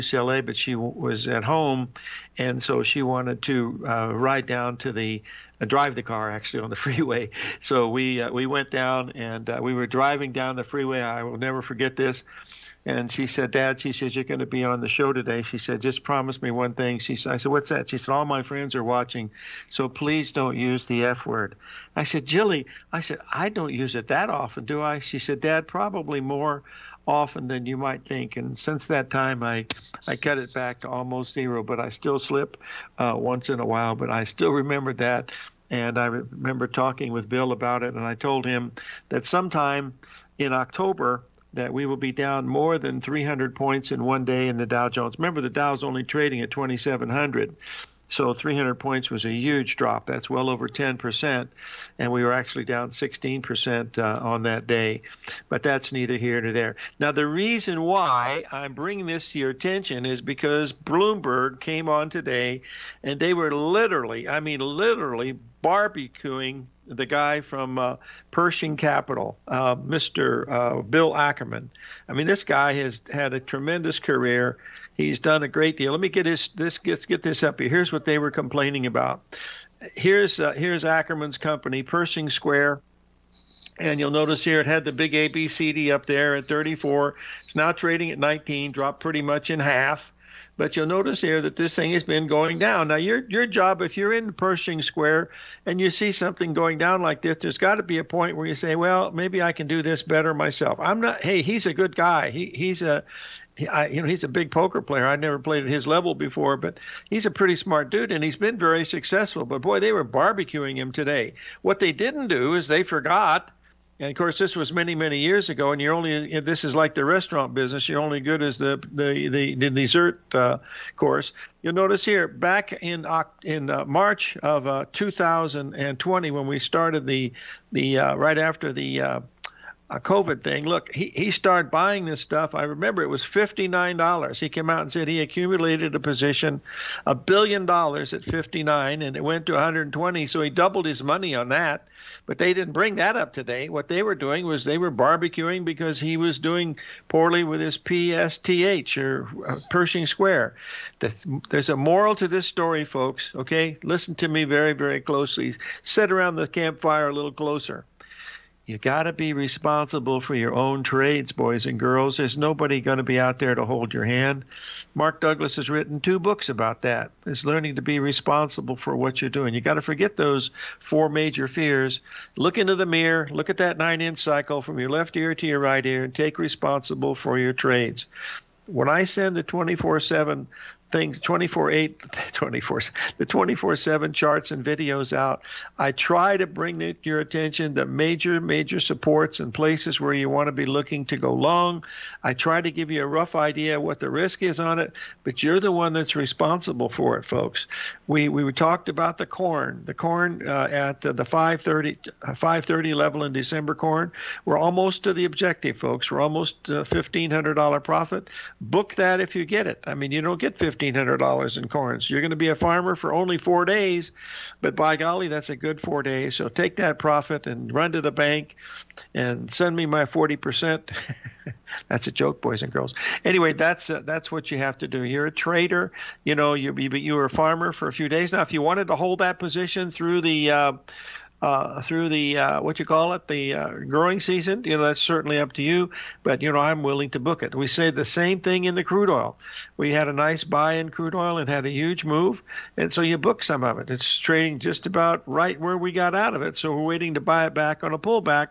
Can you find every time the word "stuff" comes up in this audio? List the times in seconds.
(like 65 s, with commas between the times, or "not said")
132 s.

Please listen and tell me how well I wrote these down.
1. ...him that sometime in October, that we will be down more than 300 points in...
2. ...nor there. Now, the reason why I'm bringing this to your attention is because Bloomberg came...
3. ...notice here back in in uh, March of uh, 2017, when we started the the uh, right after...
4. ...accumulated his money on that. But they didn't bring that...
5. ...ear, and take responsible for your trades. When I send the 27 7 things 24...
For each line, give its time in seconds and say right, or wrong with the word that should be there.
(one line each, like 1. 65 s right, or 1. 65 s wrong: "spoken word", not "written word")
1. 38 s right
2. 56 s right
3. 121 s wrong: "2020", not "2017"
4. 140 s wrong: "doubled", not "accumulated"
5. 175 s wrong: "24", not "27".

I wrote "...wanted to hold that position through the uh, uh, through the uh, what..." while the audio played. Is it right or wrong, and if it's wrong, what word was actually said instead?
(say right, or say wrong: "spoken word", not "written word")
right.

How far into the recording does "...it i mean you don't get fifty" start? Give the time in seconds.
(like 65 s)
209 s.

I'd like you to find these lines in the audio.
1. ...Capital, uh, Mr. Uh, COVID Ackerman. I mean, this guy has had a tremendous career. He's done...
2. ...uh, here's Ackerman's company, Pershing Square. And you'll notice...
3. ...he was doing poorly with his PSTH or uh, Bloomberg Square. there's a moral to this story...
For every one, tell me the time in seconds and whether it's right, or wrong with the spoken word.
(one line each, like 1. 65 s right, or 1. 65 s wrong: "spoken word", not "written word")
1. 68 s wrong: "Bill", not "COVID"
2. 80 s right
3. 145 s wrong: "Pershing", not "Bloomberg".